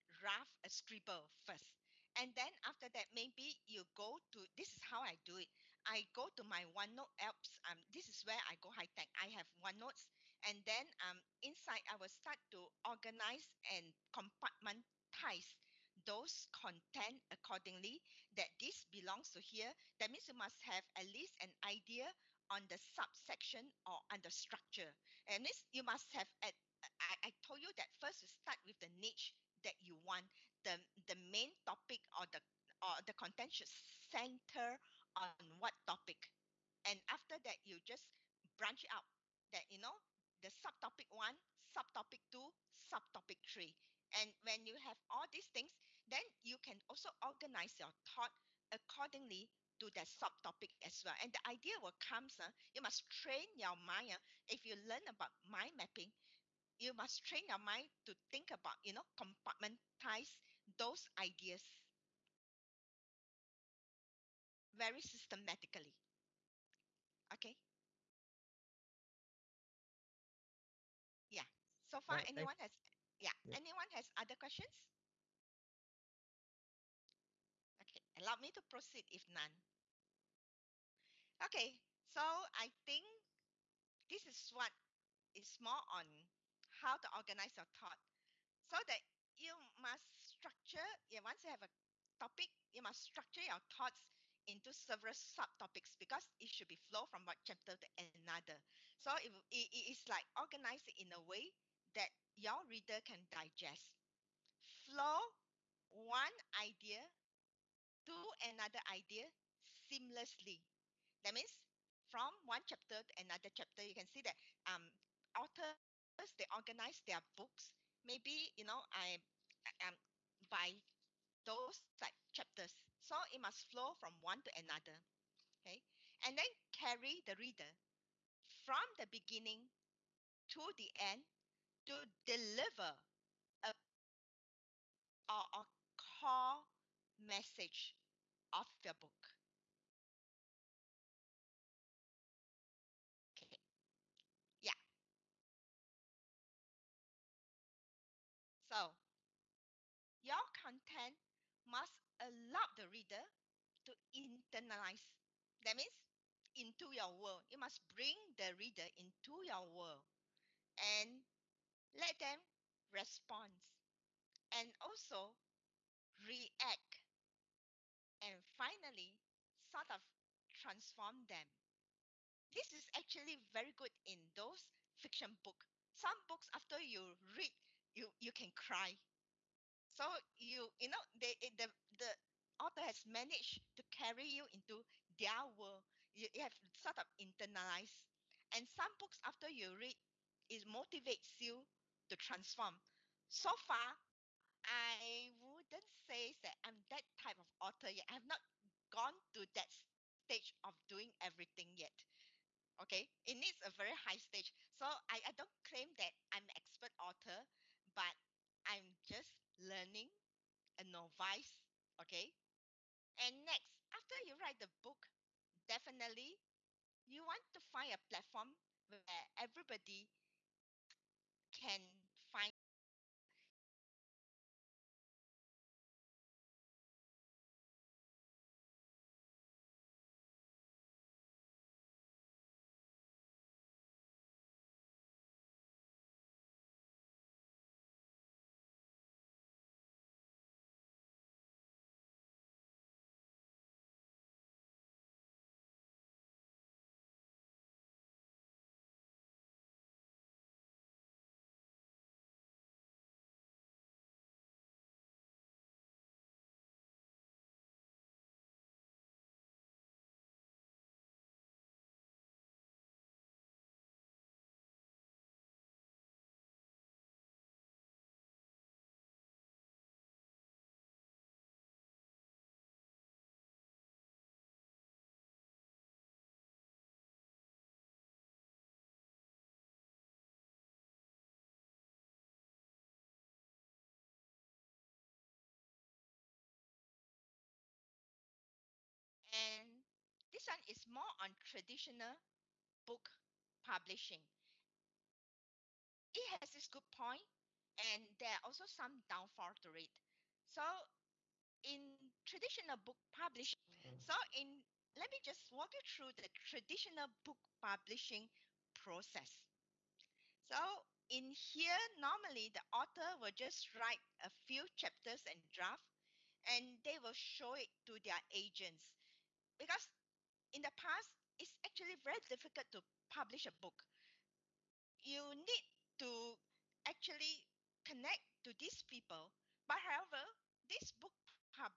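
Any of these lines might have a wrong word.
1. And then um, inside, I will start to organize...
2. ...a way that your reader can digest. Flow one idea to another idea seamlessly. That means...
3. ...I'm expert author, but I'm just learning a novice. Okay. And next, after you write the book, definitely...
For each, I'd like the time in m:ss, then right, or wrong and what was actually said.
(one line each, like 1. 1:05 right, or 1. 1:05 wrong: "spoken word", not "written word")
1. 0:10 right
2. 1:41 right
3. 3:26 right.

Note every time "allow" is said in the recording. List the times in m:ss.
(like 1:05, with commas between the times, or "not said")
1:18, 2:32.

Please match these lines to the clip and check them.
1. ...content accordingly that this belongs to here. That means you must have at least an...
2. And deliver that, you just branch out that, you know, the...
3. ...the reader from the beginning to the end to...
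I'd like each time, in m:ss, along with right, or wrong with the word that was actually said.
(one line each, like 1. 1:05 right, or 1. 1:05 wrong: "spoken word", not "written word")
1. 0:16 right
2. 0:36 wrong: "after", not "deliver"
3. 2:07 right.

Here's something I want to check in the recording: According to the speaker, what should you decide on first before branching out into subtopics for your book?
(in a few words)
The niche.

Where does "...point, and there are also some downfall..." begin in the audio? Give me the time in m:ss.
4:56.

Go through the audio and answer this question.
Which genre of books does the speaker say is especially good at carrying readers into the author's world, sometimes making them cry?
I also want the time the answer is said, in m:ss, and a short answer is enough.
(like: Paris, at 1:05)
Fiction, at 2:54.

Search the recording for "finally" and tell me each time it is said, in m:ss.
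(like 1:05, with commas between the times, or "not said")
2:48.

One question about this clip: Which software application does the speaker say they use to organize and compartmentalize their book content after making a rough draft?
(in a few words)
OneNote.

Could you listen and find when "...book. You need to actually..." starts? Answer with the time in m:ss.
5:23.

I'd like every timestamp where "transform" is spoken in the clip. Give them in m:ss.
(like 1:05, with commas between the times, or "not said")
2:50, 3:12.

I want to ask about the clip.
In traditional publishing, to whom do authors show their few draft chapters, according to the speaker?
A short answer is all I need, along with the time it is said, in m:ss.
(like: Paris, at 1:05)
Their agents, at 5:17.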